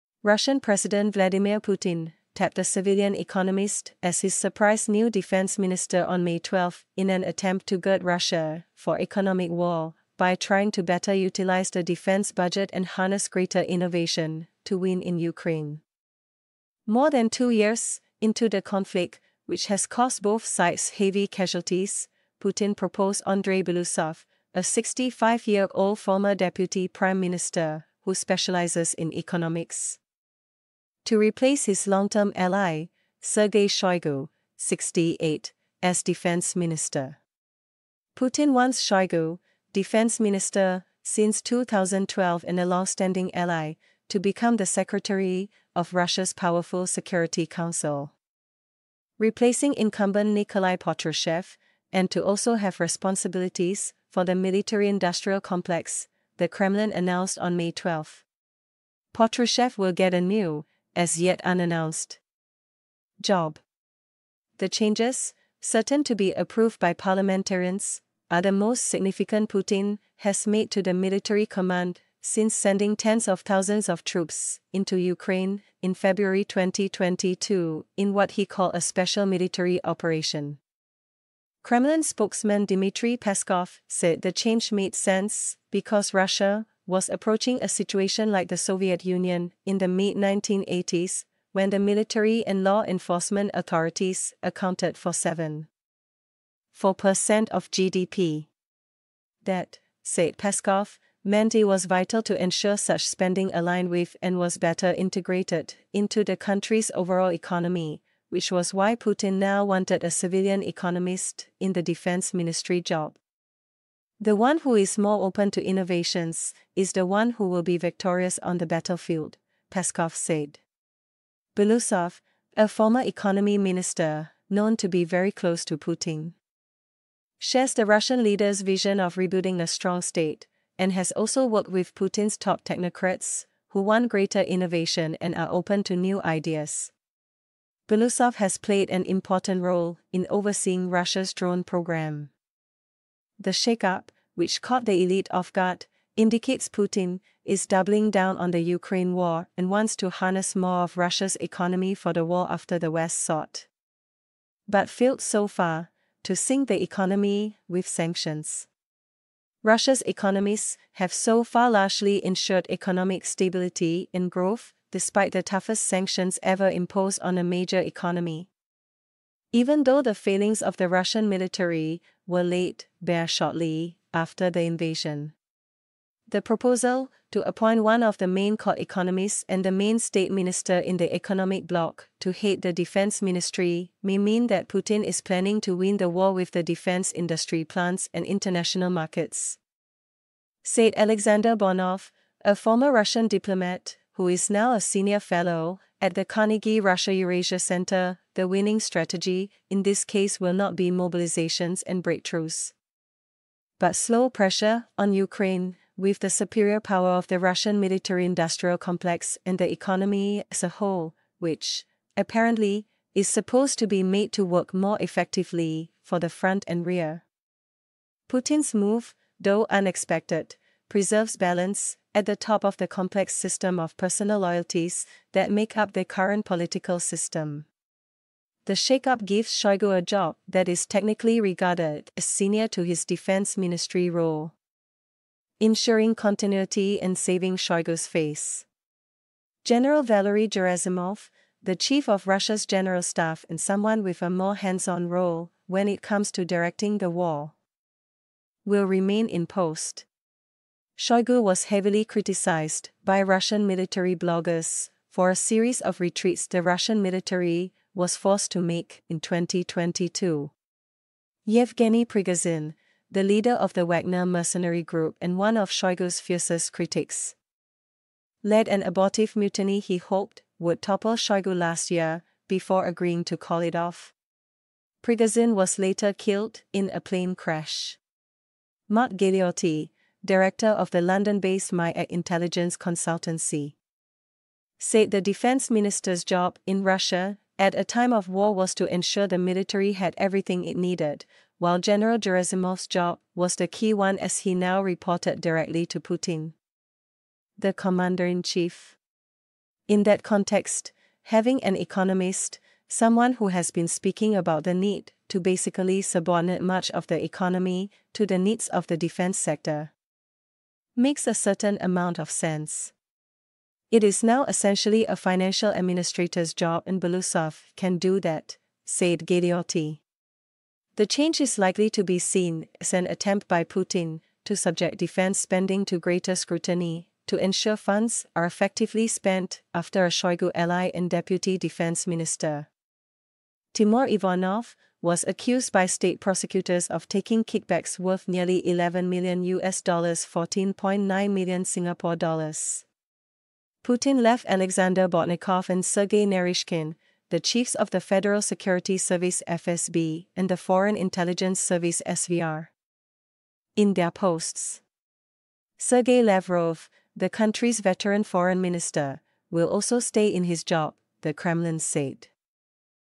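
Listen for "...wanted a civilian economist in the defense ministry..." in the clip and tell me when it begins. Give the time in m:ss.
1:49.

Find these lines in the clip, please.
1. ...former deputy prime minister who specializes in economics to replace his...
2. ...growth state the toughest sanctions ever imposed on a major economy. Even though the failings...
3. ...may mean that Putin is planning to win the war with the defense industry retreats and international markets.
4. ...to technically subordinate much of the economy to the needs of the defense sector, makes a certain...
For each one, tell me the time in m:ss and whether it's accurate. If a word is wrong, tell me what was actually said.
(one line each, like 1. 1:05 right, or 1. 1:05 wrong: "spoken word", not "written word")
1. 0:25 right
2. 2:44 wrong: "despite", not "state"
3. 3:04 wrong: "plants", not "retreats"
4. 5:05 wrong: "basically", not "technically".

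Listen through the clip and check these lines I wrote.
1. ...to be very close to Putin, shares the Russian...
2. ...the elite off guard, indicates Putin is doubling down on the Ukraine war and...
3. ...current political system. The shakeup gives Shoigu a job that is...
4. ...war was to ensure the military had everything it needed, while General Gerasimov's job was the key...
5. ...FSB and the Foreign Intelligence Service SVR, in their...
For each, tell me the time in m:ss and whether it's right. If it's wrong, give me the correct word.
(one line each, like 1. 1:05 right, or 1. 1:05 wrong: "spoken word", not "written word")
1. 2:04 right
2. 2:24 right
3. 3:46 right
4. 4:48 right
5. 5:49 right.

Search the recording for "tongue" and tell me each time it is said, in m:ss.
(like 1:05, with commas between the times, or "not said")
not said.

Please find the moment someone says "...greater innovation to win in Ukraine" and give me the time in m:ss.
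0:13.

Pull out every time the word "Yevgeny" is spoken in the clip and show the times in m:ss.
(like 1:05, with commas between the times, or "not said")
4:21.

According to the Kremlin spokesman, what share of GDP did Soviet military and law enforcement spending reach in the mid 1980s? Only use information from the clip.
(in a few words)
7.4%.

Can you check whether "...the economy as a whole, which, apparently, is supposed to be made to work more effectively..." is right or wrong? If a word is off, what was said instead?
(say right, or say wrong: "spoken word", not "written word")
right.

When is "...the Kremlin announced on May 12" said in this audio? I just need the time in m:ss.
0:56.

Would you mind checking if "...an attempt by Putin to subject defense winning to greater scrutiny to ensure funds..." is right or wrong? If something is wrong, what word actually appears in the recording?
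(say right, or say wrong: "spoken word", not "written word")
wrong: "spending", not "winning".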